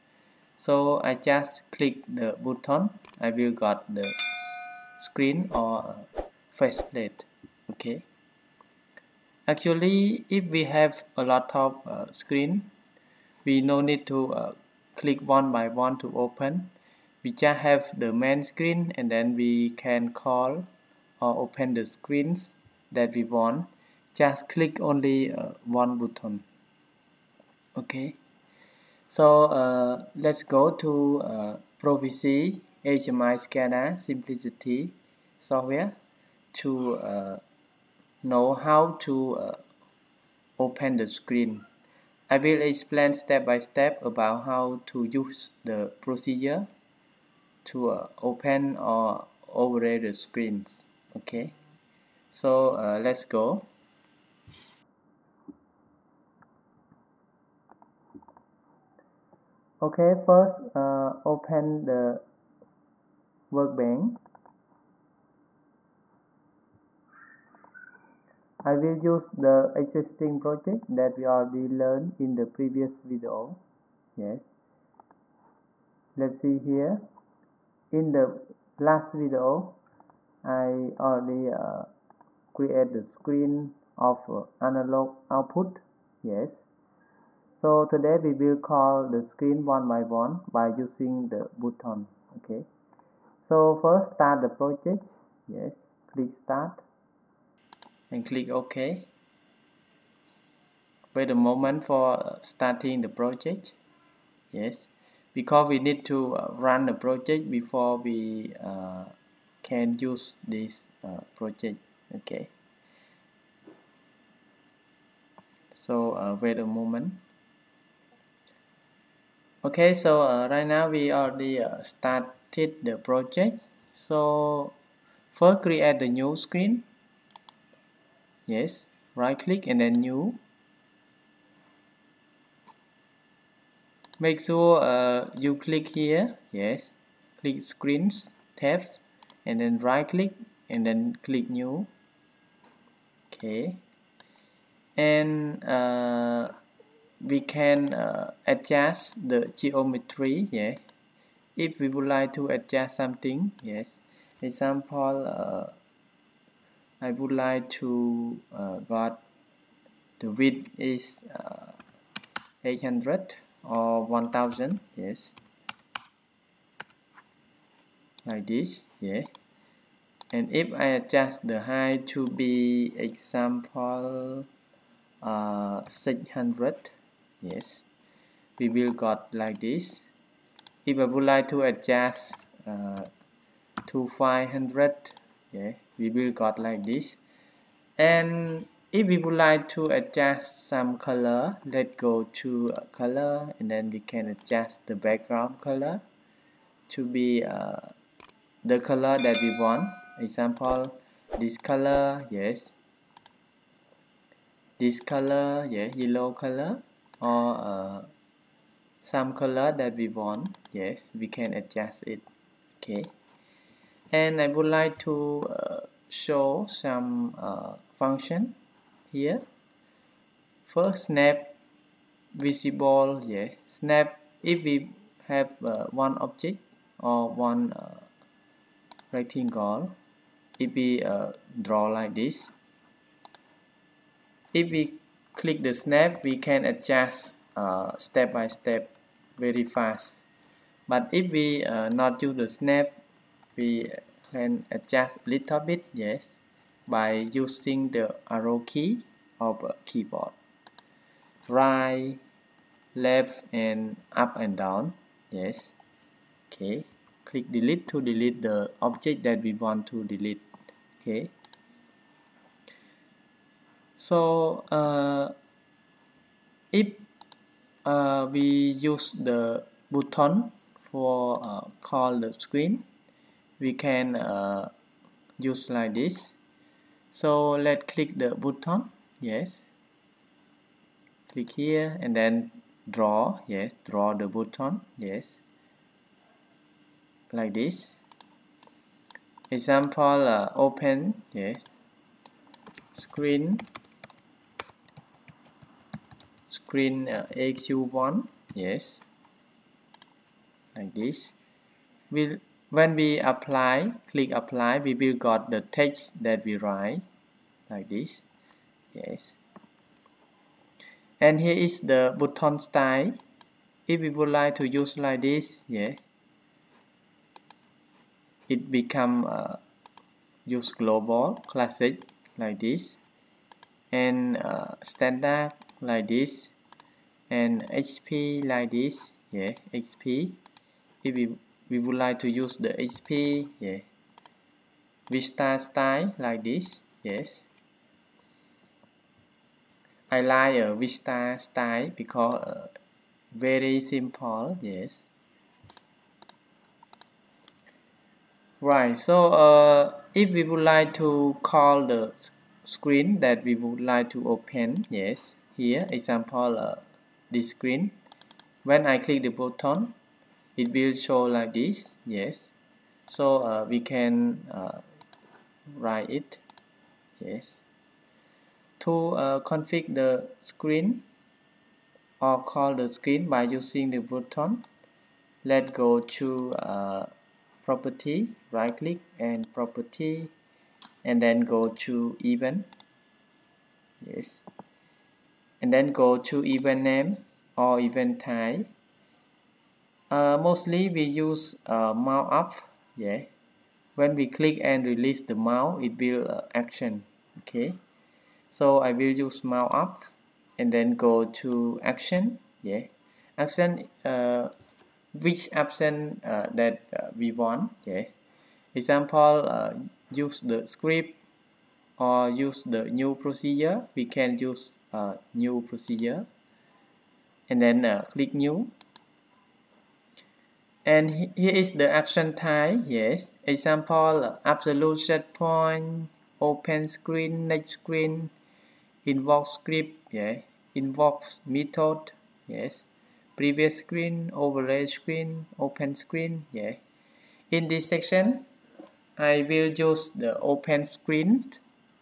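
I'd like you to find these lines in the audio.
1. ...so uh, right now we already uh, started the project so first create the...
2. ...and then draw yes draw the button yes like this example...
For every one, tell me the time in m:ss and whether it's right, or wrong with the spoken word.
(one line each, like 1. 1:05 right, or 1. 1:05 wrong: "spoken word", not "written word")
1. 1:59 right
2. 4:42 right.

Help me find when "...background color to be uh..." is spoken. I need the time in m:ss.
3:14.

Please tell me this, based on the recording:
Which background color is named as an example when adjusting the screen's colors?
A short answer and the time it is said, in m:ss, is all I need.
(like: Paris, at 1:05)
yellow, at 3:25.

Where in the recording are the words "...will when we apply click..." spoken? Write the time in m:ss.
5:02.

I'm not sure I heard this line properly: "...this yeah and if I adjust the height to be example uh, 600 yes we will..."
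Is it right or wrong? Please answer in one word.
right.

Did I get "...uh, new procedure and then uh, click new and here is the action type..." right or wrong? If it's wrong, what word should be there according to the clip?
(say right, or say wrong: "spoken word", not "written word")
right.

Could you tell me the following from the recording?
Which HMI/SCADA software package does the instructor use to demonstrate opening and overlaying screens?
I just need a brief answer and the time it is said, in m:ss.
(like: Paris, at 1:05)
Cimplicity, at 0:34.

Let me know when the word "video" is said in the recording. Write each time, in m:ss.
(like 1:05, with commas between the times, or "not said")
1:13, 1:19.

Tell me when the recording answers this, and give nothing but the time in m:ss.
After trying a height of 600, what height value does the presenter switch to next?
3:04.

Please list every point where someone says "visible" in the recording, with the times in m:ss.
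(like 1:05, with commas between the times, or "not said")
3:42.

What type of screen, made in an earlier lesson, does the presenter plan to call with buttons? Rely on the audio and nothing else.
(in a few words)
analog output.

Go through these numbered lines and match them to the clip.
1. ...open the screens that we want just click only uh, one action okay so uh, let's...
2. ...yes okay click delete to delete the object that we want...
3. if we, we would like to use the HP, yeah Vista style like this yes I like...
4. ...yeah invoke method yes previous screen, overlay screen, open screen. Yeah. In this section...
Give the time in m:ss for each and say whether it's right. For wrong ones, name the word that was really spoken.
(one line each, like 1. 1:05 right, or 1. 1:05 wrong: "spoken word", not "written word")
1. 0:21 wrong: "button", not "action"
2. 4:15 right
3. 5:31 right
4. 7:10 right.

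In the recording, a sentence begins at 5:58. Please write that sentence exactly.
When I click the button, it will show like this, yes.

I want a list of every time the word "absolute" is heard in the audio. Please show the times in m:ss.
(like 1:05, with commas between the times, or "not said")
7:04.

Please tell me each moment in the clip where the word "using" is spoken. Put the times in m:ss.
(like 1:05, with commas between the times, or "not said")
1:30, 4:07, 6:13.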